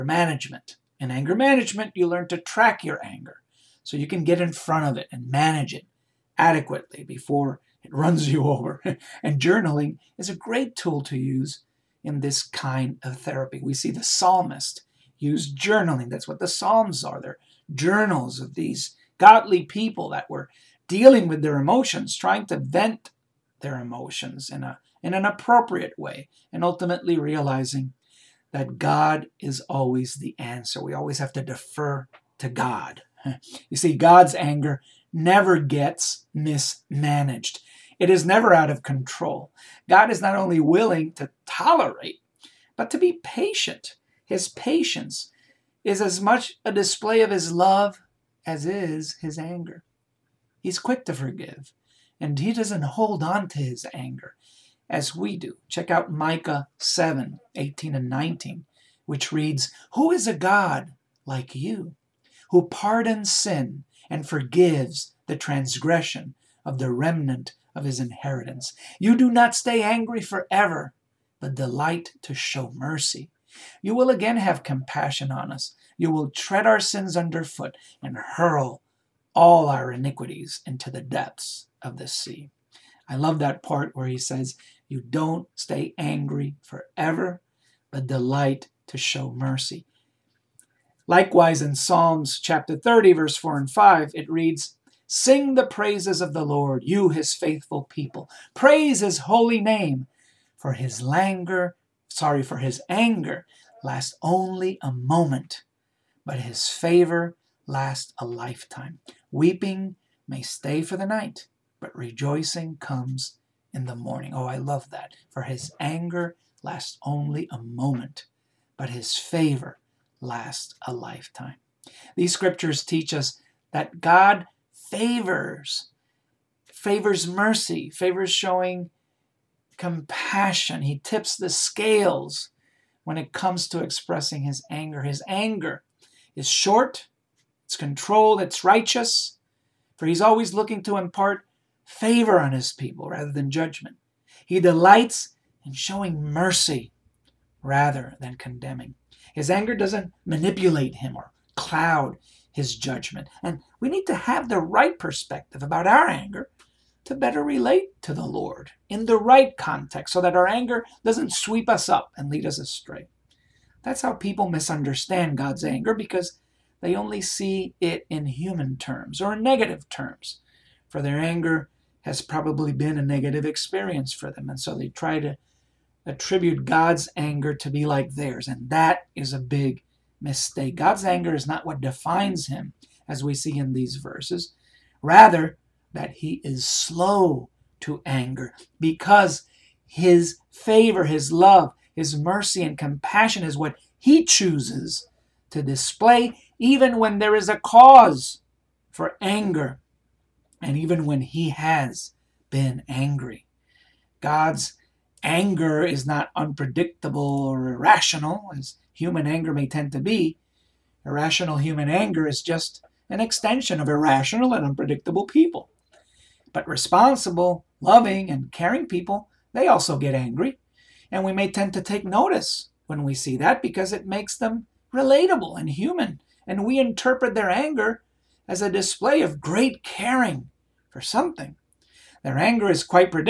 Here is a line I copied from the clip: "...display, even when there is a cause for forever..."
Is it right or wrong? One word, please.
wrong.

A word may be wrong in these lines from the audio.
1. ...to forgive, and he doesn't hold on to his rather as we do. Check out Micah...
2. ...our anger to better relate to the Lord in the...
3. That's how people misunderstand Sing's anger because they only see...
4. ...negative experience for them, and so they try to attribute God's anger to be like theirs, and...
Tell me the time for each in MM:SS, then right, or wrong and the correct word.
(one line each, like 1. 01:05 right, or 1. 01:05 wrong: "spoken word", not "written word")
1. 00:51 wrong: "anger", not "rather"
2. 02:35 right
3. 02:43 wrong: "God", not "Sing"
4. 02:53 right.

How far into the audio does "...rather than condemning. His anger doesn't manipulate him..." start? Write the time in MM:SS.
02:27.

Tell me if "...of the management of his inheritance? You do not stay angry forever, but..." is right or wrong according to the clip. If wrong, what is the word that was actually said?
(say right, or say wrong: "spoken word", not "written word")
wrong: "remnant", not "management".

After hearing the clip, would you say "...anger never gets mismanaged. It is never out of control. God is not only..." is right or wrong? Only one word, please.
right.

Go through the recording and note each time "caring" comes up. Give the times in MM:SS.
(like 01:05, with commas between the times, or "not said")
03:38, 03:49.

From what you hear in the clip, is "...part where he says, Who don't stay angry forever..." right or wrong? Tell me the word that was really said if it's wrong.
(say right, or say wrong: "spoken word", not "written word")
wrong: "You", not "Who".